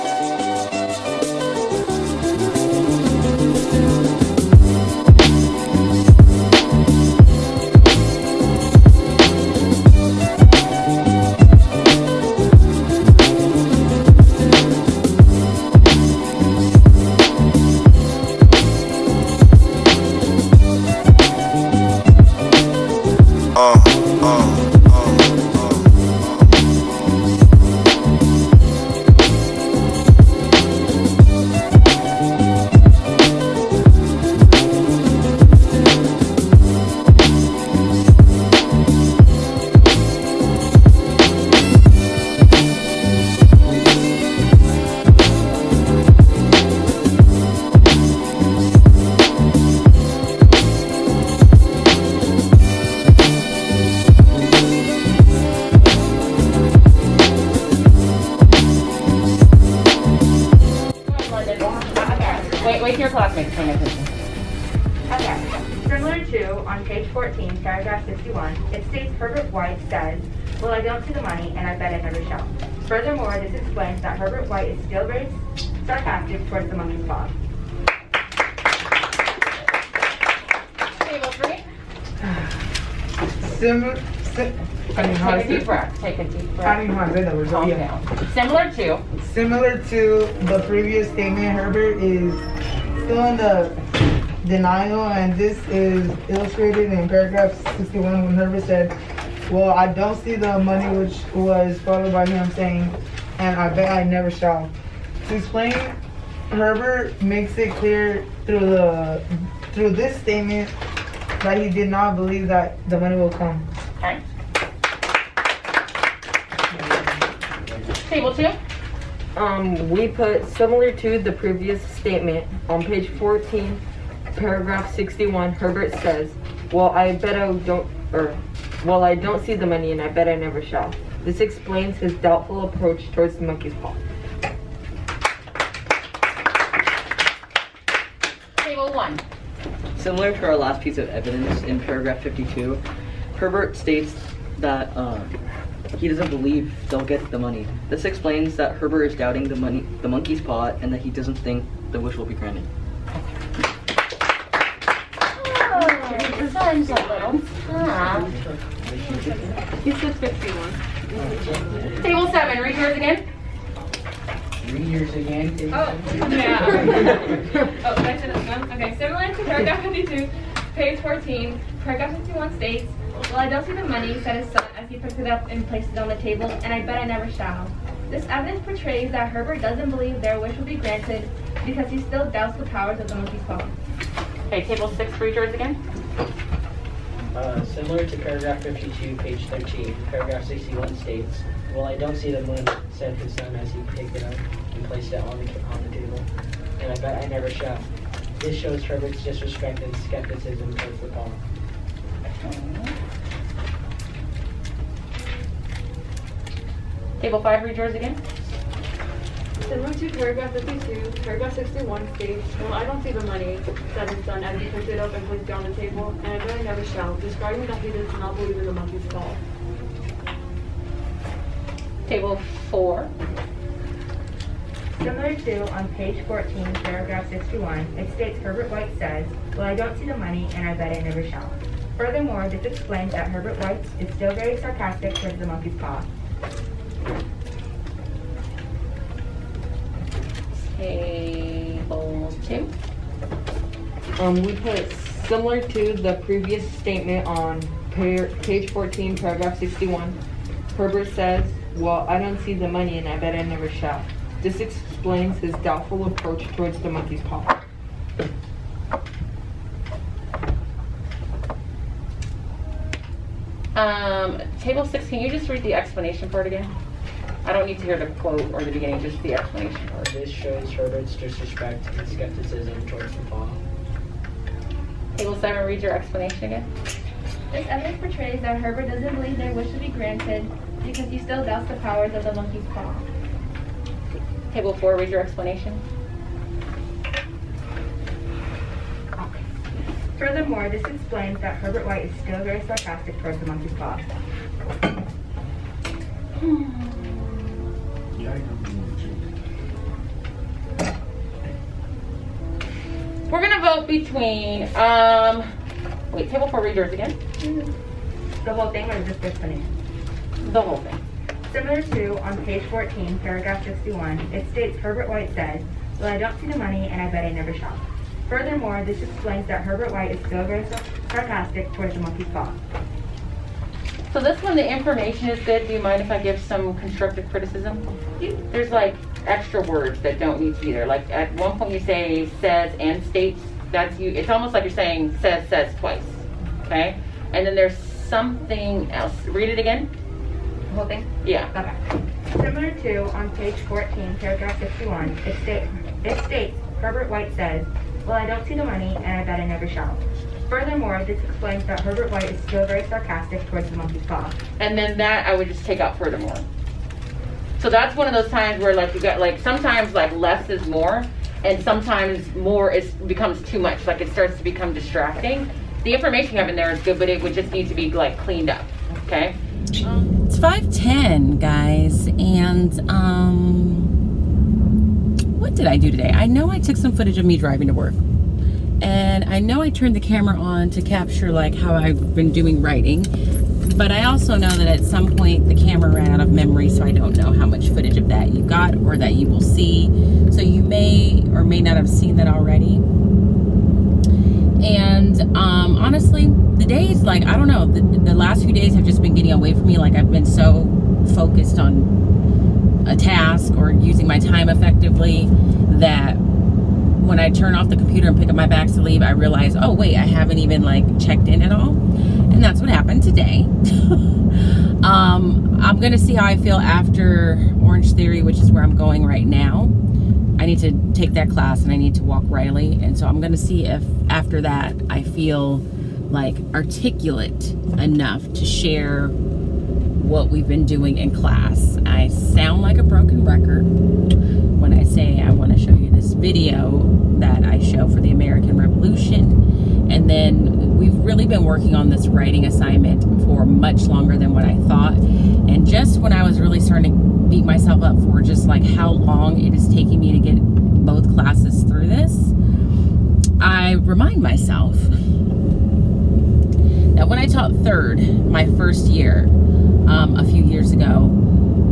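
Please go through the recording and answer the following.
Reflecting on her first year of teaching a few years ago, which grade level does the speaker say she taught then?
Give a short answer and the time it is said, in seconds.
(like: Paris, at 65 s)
third, at 457 s.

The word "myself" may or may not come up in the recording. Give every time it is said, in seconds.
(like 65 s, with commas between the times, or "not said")
447 s, 454 s.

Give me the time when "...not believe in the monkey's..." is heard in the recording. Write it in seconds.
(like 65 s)
218 s.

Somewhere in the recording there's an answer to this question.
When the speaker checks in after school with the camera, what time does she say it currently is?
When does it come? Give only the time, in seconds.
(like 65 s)
370 s.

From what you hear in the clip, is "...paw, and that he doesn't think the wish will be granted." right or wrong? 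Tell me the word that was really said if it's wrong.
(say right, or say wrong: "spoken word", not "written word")
right.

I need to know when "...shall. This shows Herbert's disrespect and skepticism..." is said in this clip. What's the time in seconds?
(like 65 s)
197 s.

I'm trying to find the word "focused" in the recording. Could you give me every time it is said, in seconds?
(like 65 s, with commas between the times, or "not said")
401 s.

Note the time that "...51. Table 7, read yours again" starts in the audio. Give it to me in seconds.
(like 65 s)
160 s.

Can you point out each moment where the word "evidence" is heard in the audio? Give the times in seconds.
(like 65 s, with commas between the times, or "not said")
141 s, 178 s, 277 s.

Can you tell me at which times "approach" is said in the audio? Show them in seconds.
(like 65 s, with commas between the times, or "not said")
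132 s, 256 s.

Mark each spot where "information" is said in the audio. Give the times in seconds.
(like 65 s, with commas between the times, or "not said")
324 s, 365 s.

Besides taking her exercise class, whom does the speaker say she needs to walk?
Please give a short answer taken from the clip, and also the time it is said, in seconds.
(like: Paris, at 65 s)
Riley, at 422 s.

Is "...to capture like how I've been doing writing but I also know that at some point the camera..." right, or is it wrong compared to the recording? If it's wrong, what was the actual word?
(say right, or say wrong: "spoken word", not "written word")
right.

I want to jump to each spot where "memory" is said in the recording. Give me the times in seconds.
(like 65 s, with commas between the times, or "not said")
386 s.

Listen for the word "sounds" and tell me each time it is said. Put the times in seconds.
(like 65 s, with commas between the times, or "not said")
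156 s, 432 s.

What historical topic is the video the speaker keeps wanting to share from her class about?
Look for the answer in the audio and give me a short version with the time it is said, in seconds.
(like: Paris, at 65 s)
American Revolution, at 438 s.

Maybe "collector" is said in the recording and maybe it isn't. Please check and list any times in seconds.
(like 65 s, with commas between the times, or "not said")
not said.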